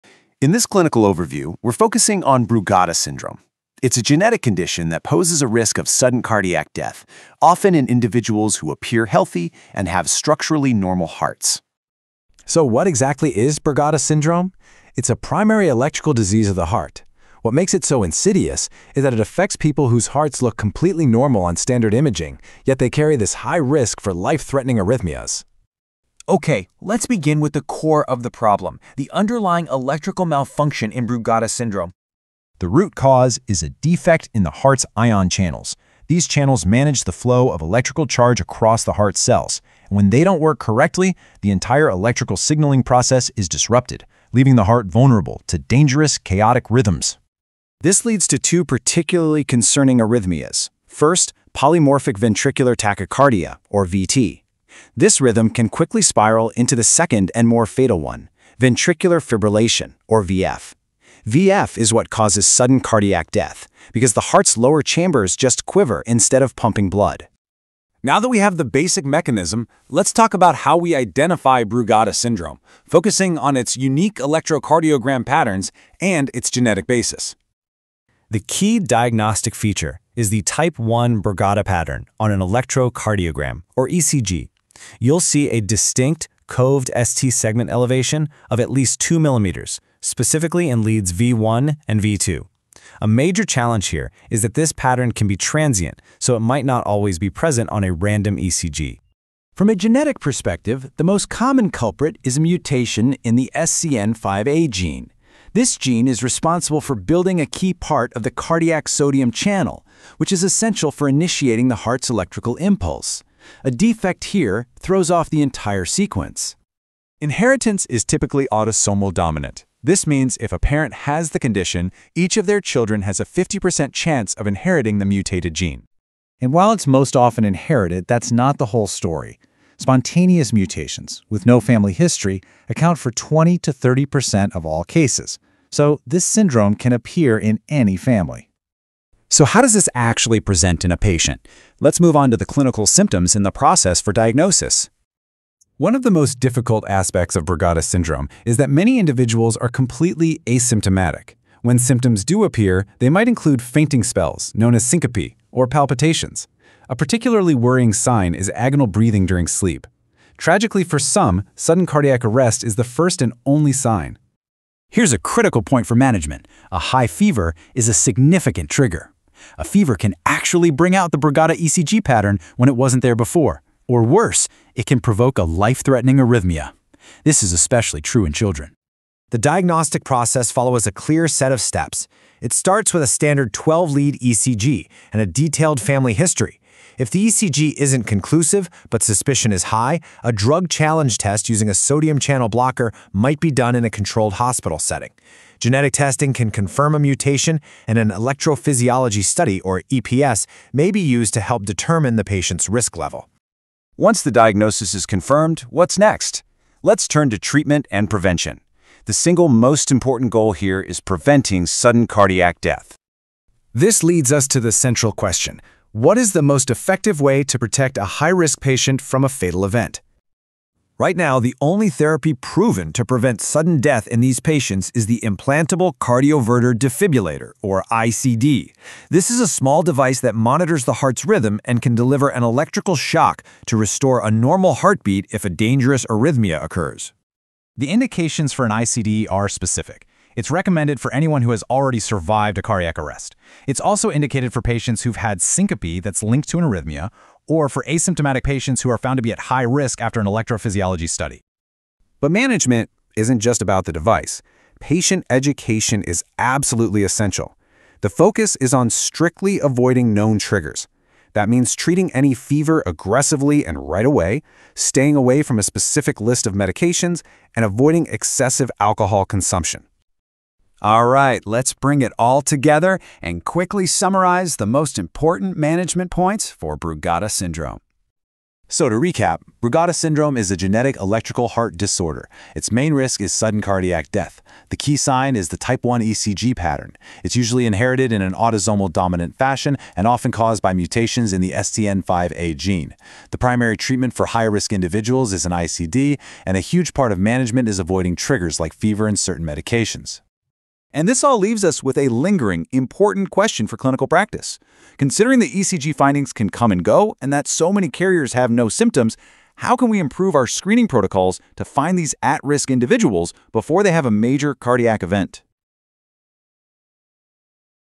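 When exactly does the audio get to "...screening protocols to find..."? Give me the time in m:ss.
5:10.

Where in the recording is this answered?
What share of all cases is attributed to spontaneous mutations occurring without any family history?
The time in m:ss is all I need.
2:13.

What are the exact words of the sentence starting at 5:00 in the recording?
And this all leaves us with a lingering, important question for clinical practice.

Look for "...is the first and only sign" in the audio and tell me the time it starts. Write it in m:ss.
2:42.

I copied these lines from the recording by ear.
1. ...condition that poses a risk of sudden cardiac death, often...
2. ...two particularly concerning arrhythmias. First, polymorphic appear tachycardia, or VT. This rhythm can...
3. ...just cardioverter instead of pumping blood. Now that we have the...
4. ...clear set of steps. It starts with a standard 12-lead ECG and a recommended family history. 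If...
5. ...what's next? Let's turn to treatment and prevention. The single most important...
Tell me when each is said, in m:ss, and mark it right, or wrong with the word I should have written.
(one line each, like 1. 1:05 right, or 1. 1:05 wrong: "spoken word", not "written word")
1. 0:04 right
2. 0:48 wrong: "ventricular", not "appear"
3. 1:05 wrong: "quiver", not "cardioverter"
4. 3:00 wrong: "detailed", not "recommended"
5. 3:25 right.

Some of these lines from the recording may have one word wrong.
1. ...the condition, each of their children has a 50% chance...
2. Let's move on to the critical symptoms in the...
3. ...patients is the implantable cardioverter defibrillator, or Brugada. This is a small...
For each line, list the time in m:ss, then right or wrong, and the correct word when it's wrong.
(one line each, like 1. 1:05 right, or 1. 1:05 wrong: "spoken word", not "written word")
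1. 2:01 right
2. 2:21 wrong: "clinical", not "critical"
3. 3:44 wrong: "ICD", not "Brugada".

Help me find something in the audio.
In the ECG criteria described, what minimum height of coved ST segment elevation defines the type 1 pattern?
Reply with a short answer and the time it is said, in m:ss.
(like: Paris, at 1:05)
2 millimeters, at 1:28.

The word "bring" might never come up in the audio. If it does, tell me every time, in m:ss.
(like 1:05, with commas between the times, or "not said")
2:50, 4:31.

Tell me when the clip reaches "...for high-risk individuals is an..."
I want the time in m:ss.
4:54.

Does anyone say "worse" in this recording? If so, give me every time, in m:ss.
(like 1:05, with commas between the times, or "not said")
2:54.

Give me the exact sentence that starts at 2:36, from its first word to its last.
A particularly worrying sign is agonal breathing during sleep.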